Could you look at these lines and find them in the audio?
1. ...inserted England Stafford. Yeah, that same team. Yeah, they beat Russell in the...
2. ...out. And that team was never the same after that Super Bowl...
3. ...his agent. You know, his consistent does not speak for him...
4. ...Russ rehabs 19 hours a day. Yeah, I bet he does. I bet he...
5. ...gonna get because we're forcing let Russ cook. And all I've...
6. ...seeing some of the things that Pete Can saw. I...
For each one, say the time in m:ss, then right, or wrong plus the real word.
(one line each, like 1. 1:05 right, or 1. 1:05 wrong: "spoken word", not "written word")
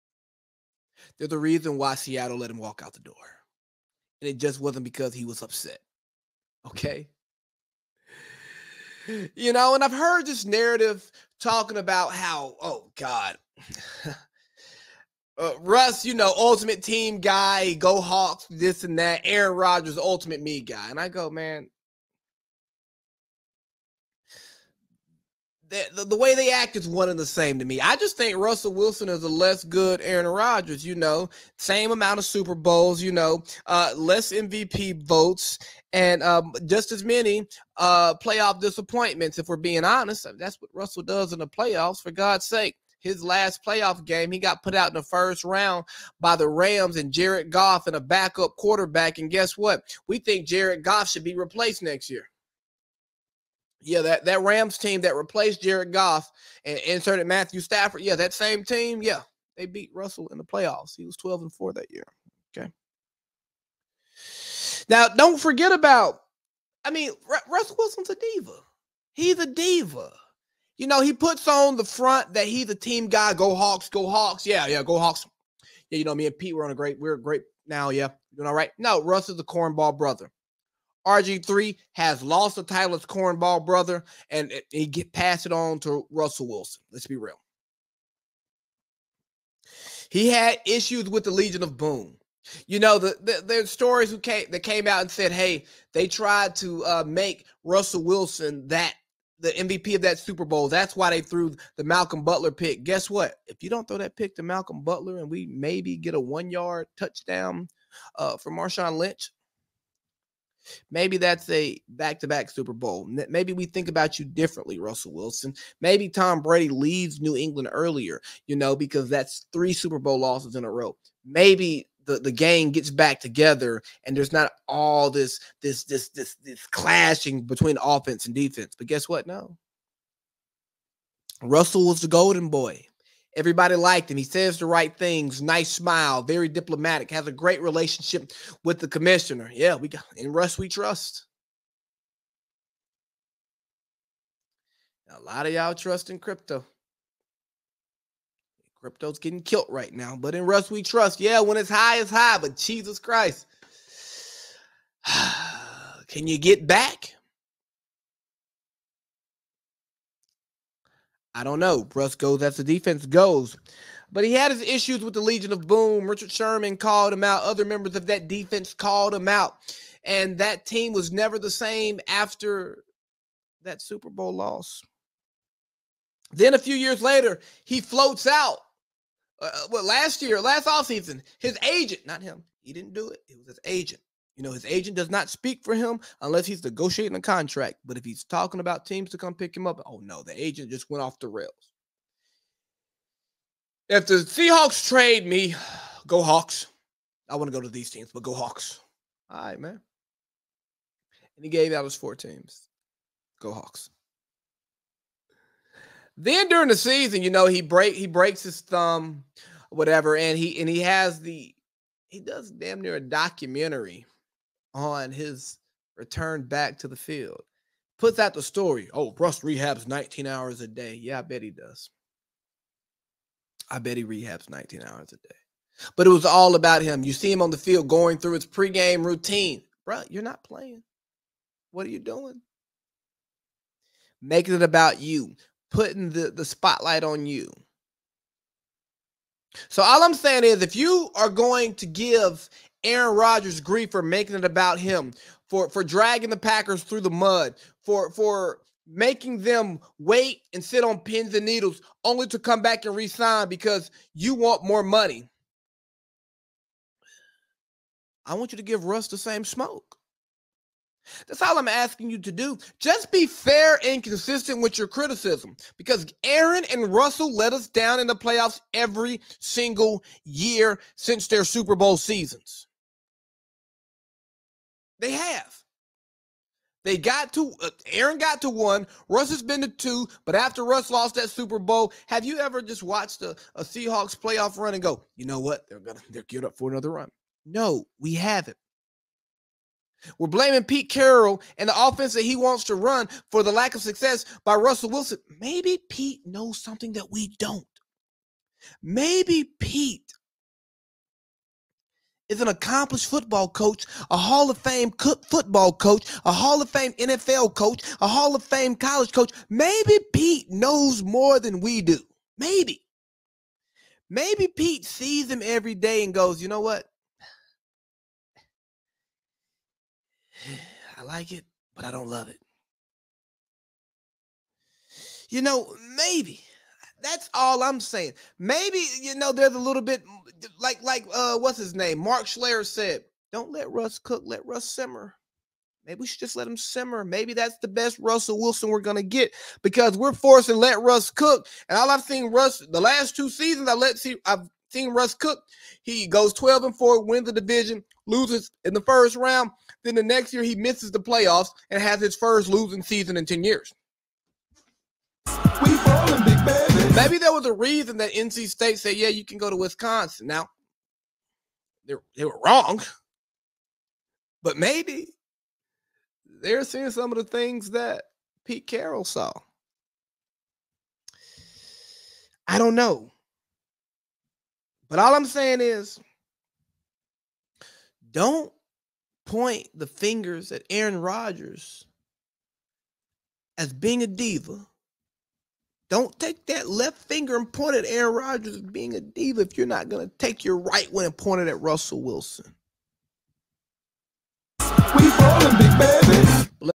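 1. 0:56 wrong: "Matthew", not "England"
2. 2:49 right
3. 3:03 wrong: "agent", not "consistent"
4. 3:39 right
5. 5:38 right
6. 6:06 wrong: "Carroll", not "Can".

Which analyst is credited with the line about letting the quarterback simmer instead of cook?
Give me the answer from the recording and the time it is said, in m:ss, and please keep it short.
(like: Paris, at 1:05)
Mark Schlereth, at 5:31.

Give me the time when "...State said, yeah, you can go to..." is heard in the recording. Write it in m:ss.
5:58.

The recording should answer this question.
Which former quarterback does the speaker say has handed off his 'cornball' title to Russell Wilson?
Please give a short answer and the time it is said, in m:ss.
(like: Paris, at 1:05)
RG3, at 1:21.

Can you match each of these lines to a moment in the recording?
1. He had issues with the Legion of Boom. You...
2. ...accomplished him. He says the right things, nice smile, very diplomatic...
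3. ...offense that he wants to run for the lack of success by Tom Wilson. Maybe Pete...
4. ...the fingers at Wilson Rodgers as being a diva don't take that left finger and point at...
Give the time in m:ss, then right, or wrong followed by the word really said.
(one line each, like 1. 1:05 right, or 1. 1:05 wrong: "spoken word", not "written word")
1. 1:30 right
2. 2:13 wrong: "liked", not "accomplished"
3. 4:51 wrong: "Russell", not "Tom"
4. 6:19 wrong: "Aaron", not "Wilson".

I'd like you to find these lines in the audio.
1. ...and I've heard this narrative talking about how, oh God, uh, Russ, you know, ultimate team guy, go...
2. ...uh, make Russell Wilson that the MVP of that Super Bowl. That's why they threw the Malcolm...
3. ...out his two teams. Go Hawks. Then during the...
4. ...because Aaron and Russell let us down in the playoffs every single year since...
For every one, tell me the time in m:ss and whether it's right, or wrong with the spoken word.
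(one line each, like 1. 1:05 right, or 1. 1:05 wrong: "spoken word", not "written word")
1. 0:09 right
2. 1:36 right
3. 3:21 wrong: "four", not "two"
4. 4:25 right.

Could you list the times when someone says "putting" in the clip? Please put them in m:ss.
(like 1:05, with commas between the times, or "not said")
3:55.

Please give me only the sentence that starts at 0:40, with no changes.
That's what Russell does in the playoffs, for God's sake.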